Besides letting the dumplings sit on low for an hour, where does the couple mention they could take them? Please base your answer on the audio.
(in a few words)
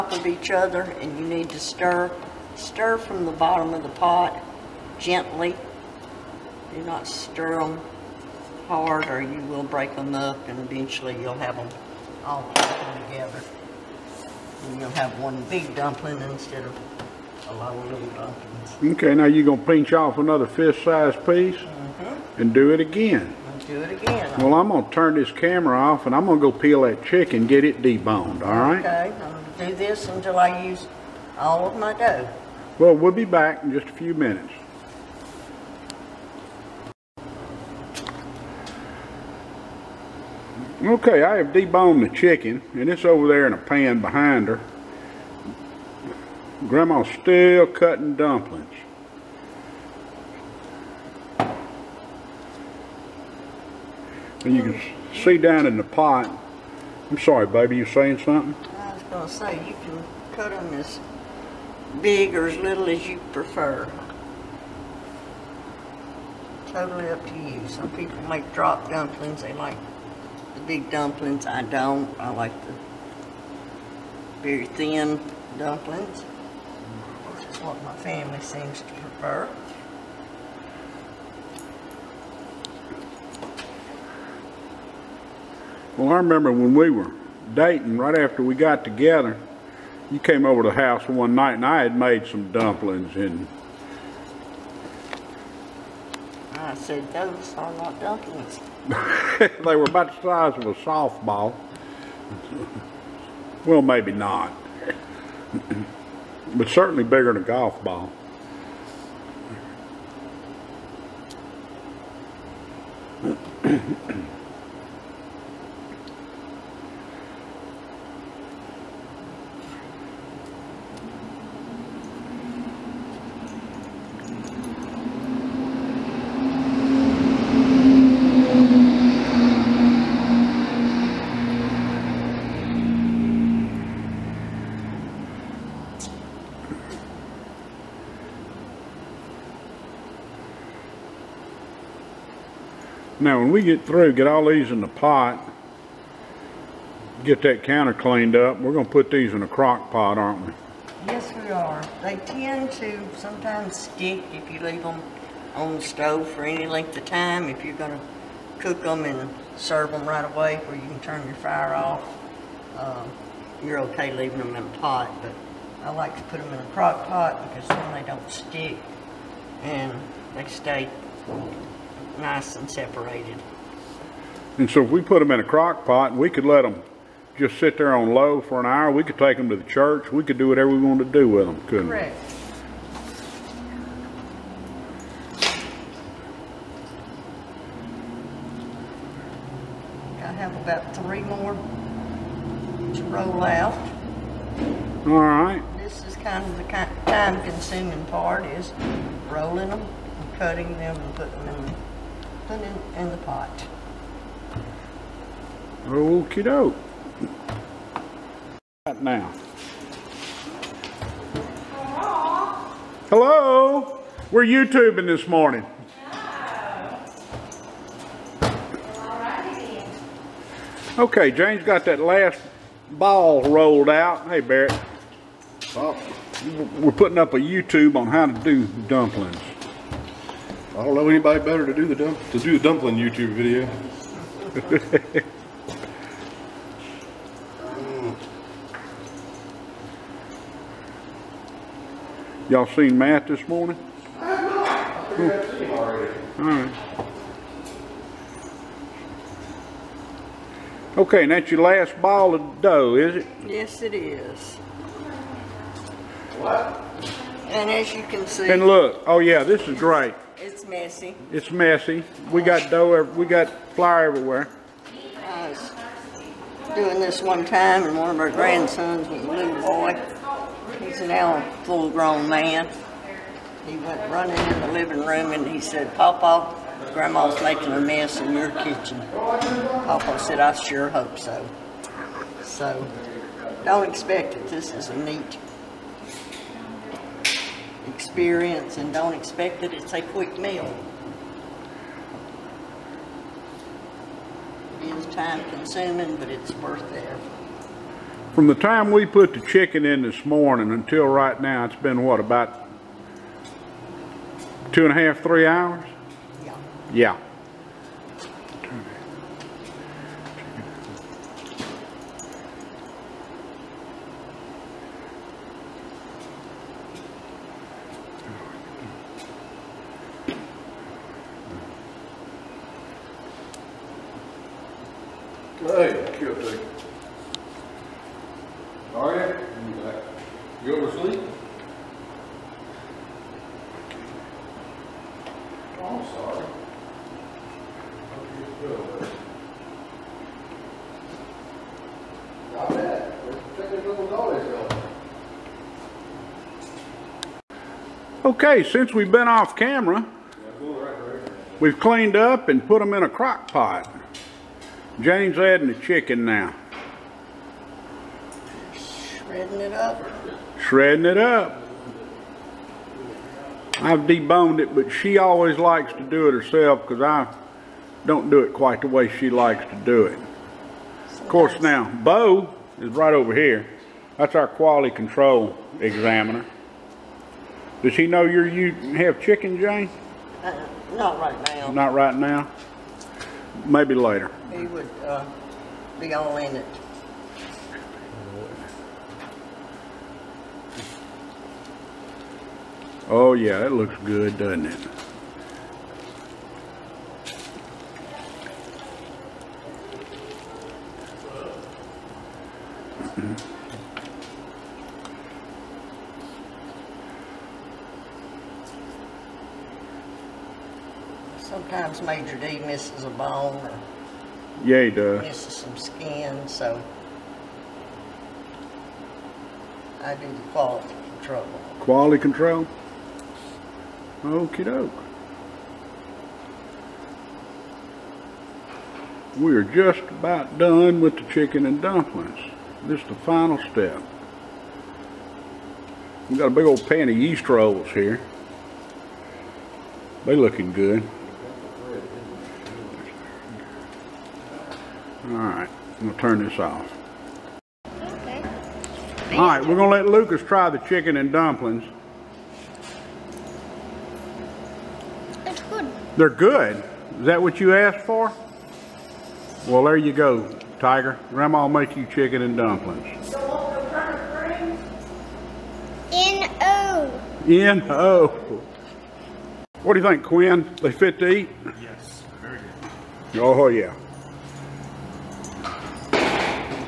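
the church.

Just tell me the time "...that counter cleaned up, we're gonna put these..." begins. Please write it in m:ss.
2:27.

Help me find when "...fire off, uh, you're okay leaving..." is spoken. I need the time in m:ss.
2:41.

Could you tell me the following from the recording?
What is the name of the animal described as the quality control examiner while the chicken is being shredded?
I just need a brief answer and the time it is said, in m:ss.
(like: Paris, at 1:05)
Bo, at 6:12.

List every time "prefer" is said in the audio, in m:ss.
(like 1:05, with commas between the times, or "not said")
1:03, 1:18.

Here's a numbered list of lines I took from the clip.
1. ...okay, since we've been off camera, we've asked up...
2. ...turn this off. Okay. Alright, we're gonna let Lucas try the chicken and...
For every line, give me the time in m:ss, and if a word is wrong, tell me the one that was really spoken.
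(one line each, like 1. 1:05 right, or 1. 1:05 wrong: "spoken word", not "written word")
1. 5:48 wrong: "cleaned", not "asked"
2. 7:26 right.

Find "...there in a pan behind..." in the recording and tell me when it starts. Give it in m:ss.
0:43.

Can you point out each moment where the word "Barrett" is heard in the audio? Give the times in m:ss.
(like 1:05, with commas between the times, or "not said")
3:44.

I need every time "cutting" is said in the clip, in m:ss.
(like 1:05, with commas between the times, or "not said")
0:47, 3:20.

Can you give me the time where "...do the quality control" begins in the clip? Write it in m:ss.
7:00.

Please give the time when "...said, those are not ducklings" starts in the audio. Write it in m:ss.
1:36.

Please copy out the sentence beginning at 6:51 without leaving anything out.
Sometimes Major D misses a bone or yeah, he does.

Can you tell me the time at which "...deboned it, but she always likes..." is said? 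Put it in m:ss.
6:03.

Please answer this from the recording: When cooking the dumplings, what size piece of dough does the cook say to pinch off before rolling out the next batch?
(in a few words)
fist-sized.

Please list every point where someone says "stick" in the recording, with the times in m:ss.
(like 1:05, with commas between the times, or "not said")
2:33, 2:48.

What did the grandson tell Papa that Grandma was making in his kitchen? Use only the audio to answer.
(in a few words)
a mess.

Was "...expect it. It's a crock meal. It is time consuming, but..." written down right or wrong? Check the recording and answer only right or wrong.
wrong.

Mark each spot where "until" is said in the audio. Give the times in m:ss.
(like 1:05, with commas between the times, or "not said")
0:30, 5:00.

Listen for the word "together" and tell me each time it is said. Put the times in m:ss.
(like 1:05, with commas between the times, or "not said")
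0:13, 1:28.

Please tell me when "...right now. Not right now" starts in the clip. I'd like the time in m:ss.
6:21.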